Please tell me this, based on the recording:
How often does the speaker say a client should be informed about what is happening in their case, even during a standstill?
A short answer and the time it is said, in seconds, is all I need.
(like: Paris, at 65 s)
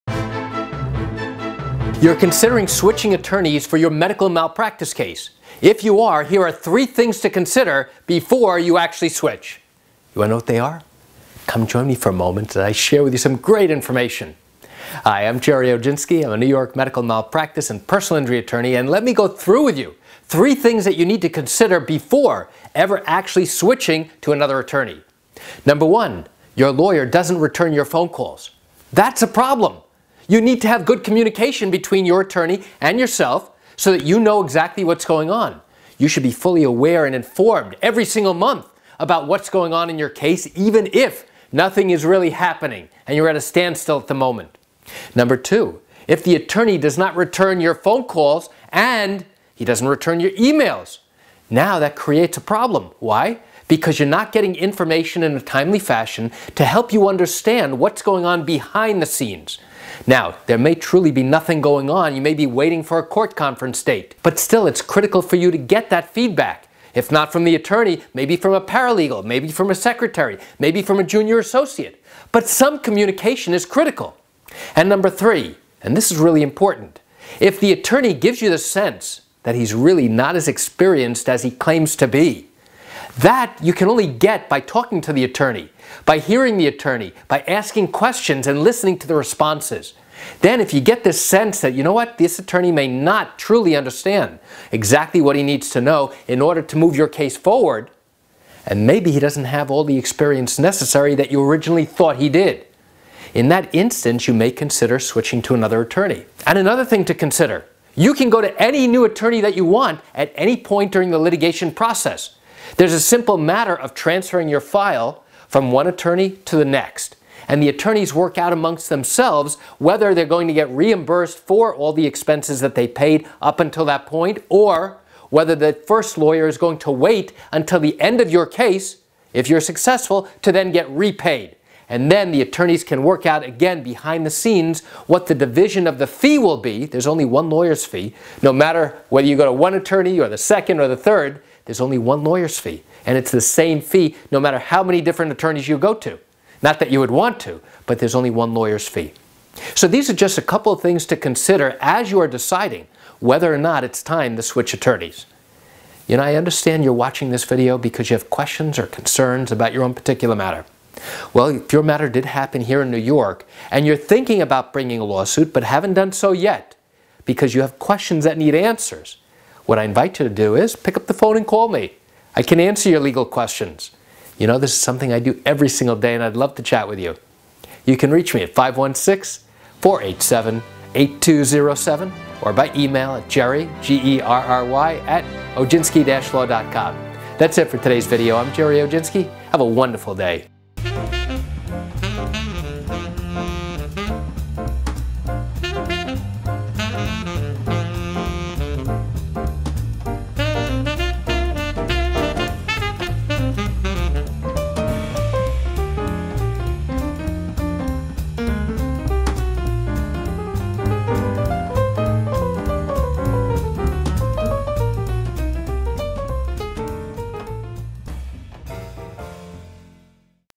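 Every single month, at 37 s.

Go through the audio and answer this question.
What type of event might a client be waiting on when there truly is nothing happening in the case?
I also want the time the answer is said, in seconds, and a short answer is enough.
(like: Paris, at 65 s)
Court conference date, at 63 s.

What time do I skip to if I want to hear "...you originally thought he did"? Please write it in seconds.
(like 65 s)
101 s.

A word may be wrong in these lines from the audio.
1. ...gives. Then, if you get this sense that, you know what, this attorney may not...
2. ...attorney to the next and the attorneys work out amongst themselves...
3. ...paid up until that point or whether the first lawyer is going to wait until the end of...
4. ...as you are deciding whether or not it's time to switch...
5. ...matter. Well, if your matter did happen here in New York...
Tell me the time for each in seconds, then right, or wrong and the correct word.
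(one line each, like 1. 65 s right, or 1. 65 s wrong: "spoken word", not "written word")
1. 89 s wrong: "responses", not "gives"
2. 115 s right
3. 122 s right
4. 151 s right
5. 160 s right.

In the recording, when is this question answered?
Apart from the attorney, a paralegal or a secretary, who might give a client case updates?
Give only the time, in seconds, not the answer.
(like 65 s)
71 s.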